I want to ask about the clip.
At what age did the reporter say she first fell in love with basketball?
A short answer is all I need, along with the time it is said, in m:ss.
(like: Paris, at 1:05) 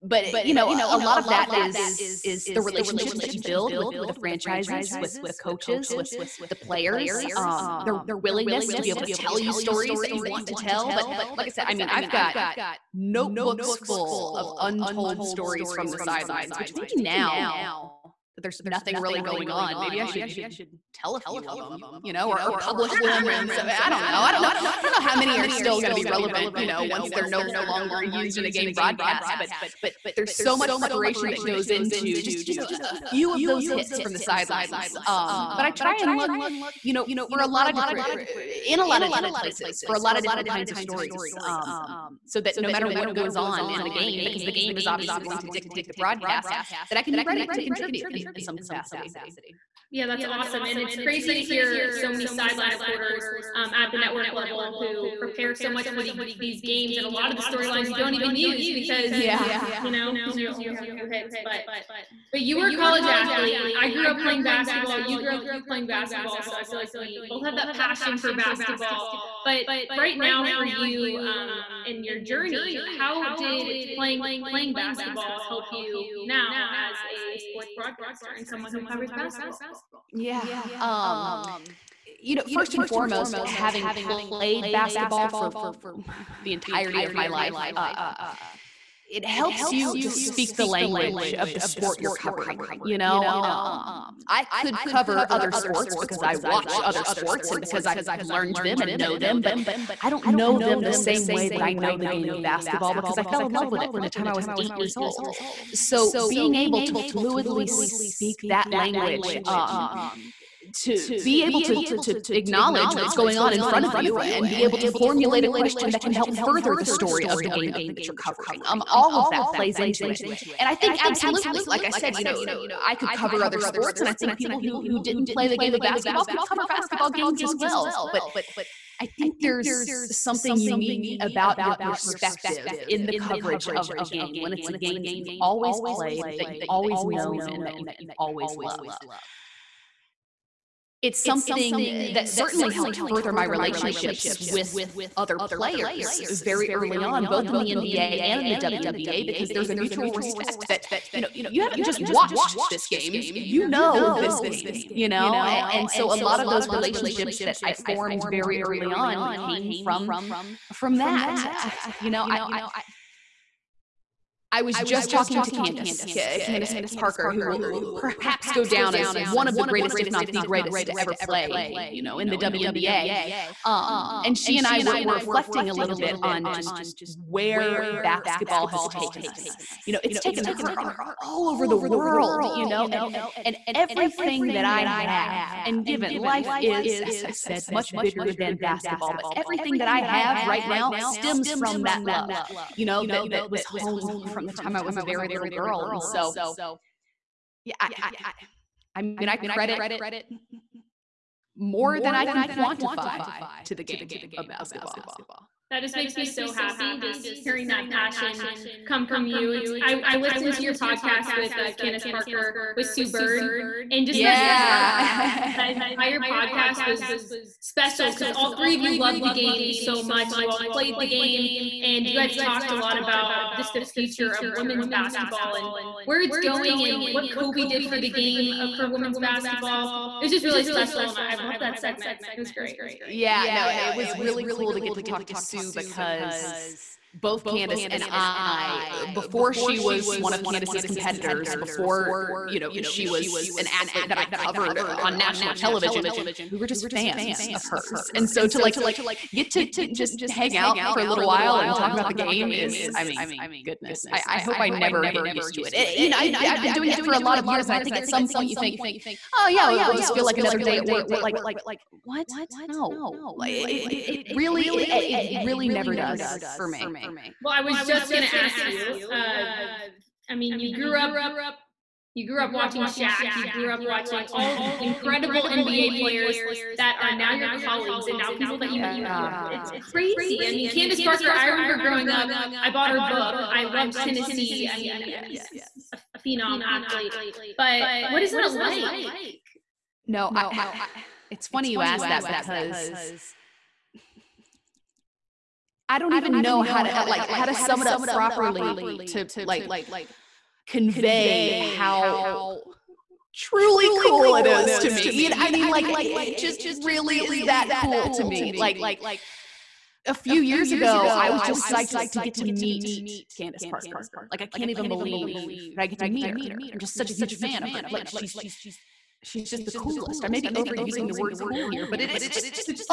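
8, at 1:44.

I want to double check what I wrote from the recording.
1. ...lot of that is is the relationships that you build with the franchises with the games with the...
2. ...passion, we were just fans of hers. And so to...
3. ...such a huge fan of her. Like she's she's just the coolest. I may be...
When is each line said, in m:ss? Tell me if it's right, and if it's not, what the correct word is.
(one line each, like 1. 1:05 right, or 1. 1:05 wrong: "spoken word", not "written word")
1. 0:00 wrong: "coaches", not "games"
2. 4:05 wrong: "television", not "passion"
3. 5:16 right.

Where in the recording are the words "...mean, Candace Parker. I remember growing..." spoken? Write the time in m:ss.
4:40.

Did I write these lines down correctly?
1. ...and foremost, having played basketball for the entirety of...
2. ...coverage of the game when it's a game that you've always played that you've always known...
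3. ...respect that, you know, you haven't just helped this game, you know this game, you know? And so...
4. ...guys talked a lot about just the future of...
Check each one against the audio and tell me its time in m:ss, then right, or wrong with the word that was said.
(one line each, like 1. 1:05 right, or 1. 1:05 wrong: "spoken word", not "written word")
1. 1:22 right
2. 2:13 right
3. 2:30 wrong: "watched", not "helped"
4. 3:42 right.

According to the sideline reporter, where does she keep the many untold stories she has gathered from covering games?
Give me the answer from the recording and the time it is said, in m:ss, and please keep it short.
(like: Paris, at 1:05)
notebooks, at 0:12.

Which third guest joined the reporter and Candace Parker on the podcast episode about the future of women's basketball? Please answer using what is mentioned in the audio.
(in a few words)
Sue Bird.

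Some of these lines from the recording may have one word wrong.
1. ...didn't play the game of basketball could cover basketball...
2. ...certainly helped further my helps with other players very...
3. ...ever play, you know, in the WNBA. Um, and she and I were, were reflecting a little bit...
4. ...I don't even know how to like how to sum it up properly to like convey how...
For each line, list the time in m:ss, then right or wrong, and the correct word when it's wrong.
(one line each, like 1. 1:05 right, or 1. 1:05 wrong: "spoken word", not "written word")
1. 2:04 right
2. 2:22 wrong: "relationships", not "helps"
3. 2:50 right
4. 4:55 right.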